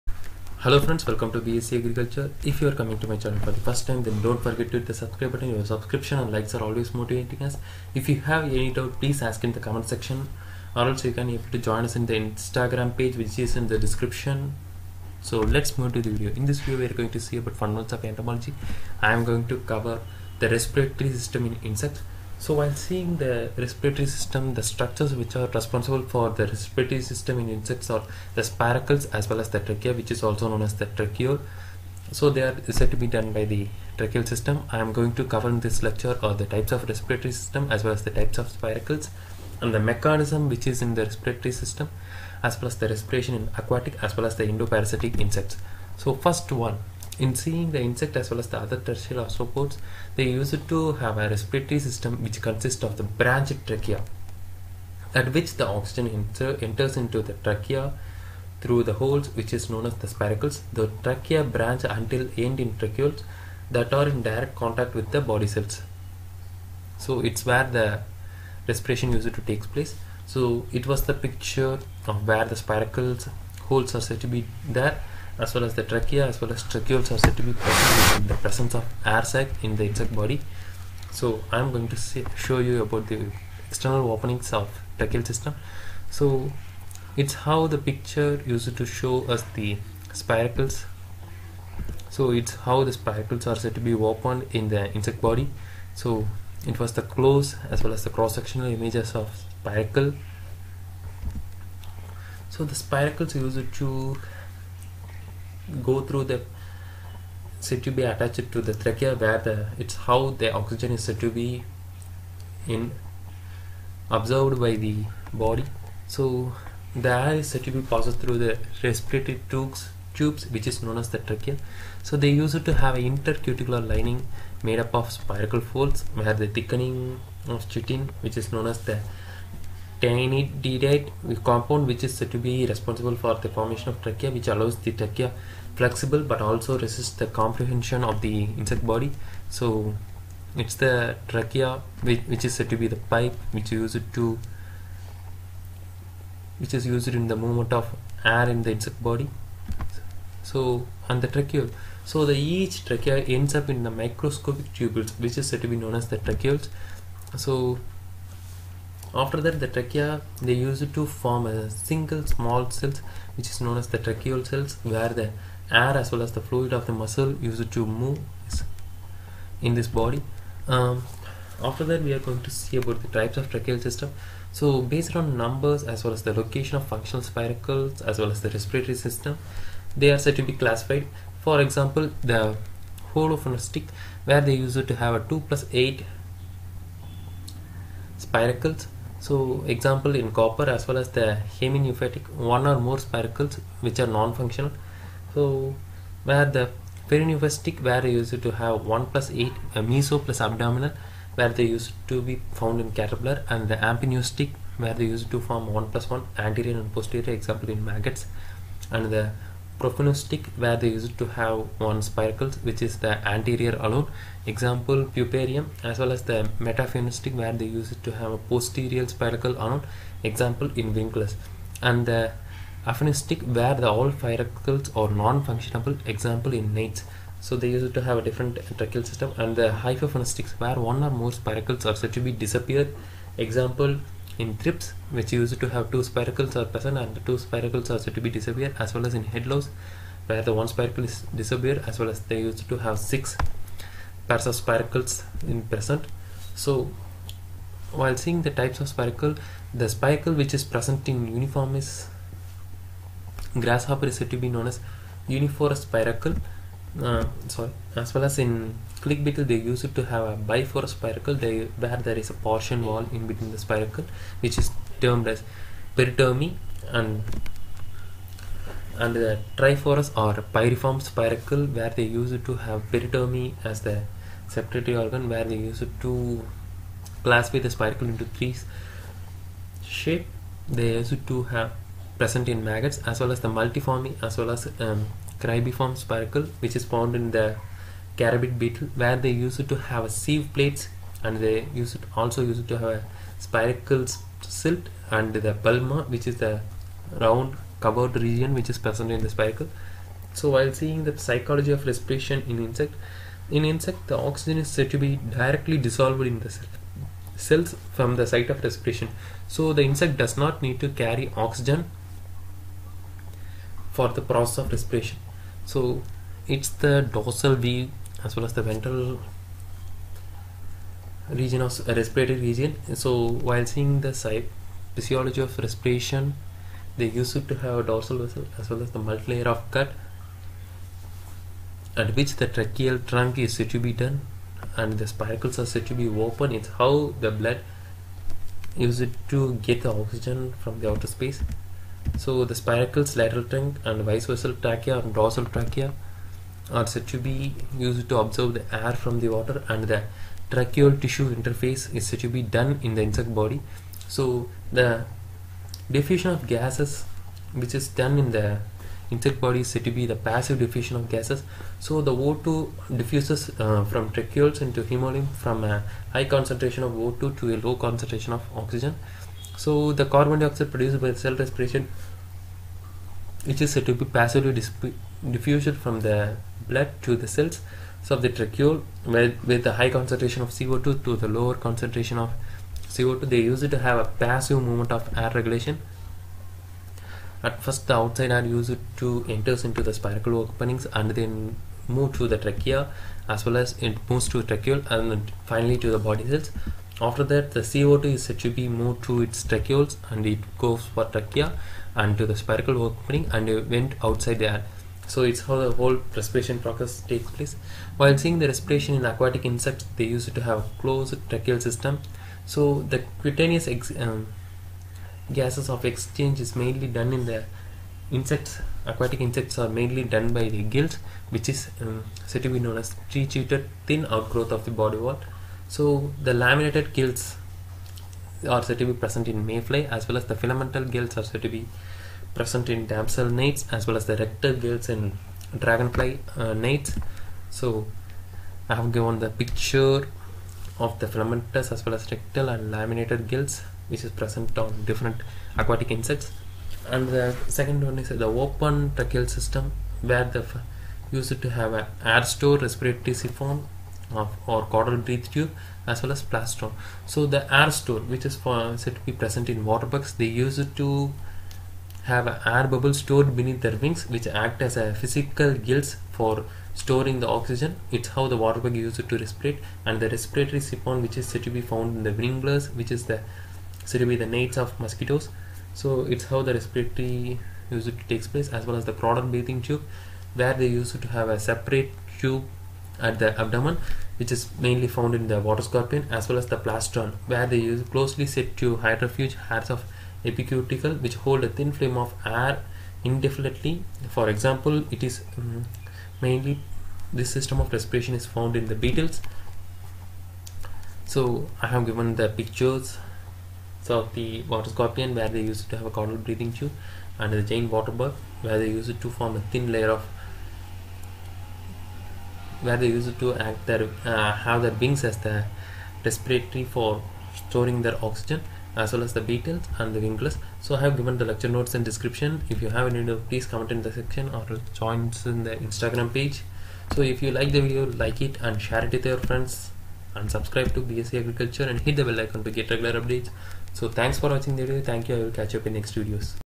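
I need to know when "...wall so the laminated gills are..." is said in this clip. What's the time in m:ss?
7:04.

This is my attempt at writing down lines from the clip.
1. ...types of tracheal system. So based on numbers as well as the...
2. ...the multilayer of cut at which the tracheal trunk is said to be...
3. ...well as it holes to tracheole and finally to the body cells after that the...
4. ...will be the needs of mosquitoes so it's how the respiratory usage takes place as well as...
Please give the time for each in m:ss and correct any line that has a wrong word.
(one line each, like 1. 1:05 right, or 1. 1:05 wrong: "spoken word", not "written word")
1. 2:53 right
2. 5:28 right
3. 6:33 wrong: "moves", not "holes"
4. 7:54 right.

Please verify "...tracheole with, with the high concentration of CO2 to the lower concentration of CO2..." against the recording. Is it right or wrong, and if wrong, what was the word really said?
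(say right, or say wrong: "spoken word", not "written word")
right.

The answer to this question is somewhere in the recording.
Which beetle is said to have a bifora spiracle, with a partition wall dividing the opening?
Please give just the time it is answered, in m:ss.
4:19.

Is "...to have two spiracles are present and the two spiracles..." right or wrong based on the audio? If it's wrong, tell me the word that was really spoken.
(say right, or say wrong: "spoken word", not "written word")
right.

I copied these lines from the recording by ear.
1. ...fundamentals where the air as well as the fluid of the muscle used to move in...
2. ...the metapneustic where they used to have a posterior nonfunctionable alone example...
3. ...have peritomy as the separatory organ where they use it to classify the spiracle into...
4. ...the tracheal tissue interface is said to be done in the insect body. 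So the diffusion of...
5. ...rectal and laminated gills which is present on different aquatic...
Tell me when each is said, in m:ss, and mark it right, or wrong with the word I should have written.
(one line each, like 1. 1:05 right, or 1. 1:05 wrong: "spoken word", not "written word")
1. 2:44 wrong: "cells", not "fundamentals"
2. 3:36 wrong: "spiracle", not "nonfunctionable"
3. 4:32 right
4. 5:49 right
5. 7:22 right.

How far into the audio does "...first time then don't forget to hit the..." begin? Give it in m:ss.
0:03.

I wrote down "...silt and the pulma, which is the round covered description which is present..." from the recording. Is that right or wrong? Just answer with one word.
wrong.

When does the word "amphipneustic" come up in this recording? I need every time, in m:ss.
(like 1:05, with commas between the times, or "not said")
3:23.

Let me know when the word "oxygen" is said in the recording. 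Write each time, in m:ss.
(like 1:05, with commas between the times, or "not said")
0:55, 1:50, 5:04, 5:11, 5:39, 6:08, 7:47, 8:38.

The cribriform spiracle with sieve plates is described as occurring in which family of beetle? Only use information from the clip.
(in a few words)
carabid beetle.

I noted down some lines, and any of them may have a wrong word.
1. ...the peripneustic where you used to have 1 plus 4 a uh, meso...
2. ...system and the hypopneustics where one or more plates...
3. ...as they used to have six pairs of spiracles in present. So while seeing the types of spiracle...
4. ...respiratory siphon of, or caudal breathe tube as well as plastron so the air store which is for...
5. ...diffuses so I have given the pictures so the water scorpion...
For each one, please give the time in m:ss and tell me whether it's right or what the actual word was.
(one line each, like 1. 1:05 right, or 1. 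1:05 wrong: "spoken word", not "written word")
1. 3:16 wrong: "8", not "4"
2. 3:49 wrong: "spiracles", not "plates"
3. 4:02 right
4. 7:32 right
5. 8:18 wrong: "beetles", not "diffuses".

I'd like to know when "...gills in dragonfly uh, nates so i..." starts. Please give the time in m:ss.
7:14.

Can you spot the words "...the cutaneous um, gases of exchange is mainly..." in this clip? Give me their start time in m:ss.
6:52.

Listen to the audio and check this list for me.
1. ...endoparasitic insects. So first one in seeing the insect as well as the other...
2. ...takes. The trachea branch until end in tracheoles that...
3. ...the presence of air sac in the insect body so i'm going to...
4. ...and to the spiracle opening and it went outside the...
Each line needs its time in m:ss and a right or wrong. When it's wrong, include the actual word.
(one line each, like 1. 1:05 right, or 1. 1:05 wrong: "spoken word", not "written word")
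1. 0:44 right
2. 1:00 wrong: "spiracles", not "takes"
3. 1:18 right
4. 6:41 right.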